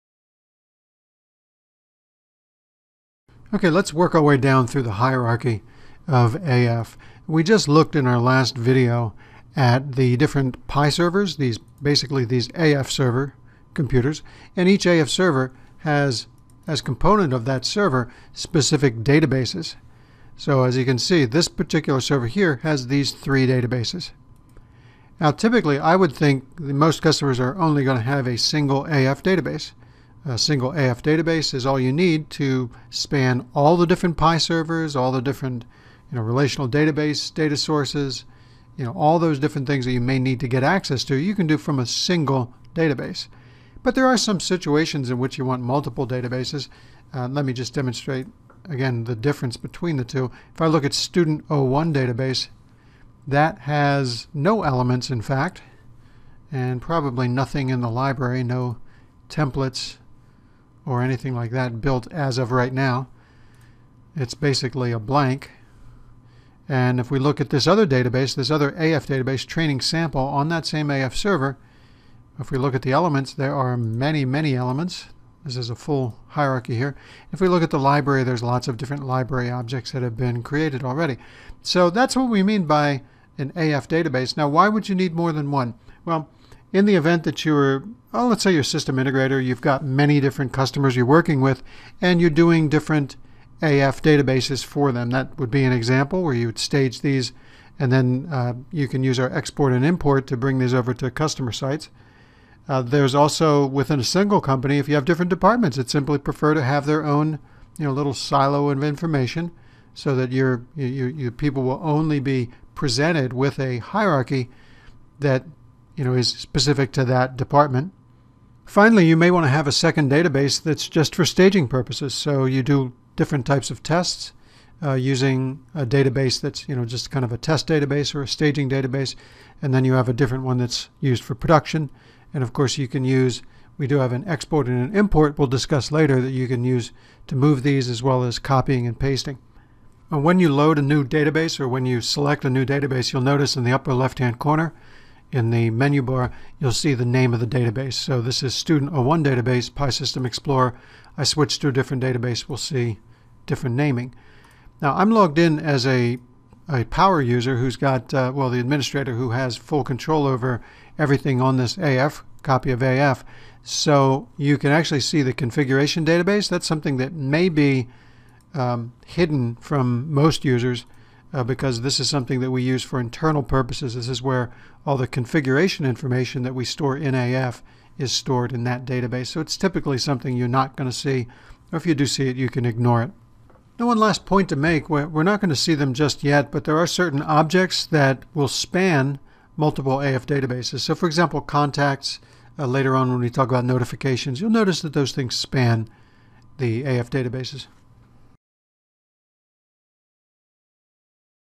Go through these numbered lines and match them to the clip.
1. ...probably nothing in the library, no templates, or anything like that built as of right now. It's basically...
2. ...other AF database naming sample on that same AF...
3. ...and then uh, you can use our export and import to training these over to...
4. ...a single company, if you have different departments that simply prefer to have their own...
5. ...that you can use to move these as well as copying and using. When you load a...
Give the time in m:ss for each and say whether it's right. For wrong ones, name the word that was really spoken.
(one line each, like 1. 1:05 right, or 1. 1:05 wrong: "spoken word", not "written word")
1. 0:56 right
2. 1:08 wrong: "training", not "naming"
3. 1:37 wrong: "bring", not "training"
4. 1:43 right
5. 2:16 wrong: "pasting", not "using".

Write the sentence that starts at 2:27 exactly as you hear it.
So this is Student 01 database, PI System Explorer.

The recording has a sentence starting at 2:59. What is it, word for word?
So it's typically something you're not going to see, or if you do see it, you can ignore it.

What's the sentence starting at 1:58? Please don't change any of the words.
Finally, you may want to have a second database that's just for staging purposes.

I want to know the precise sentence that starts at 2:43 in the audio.
So you can actually see the configuration database.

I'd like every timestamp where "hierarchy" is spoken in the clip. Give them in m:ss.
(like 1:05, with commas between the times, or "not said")
0:04, 1:16, 1:53.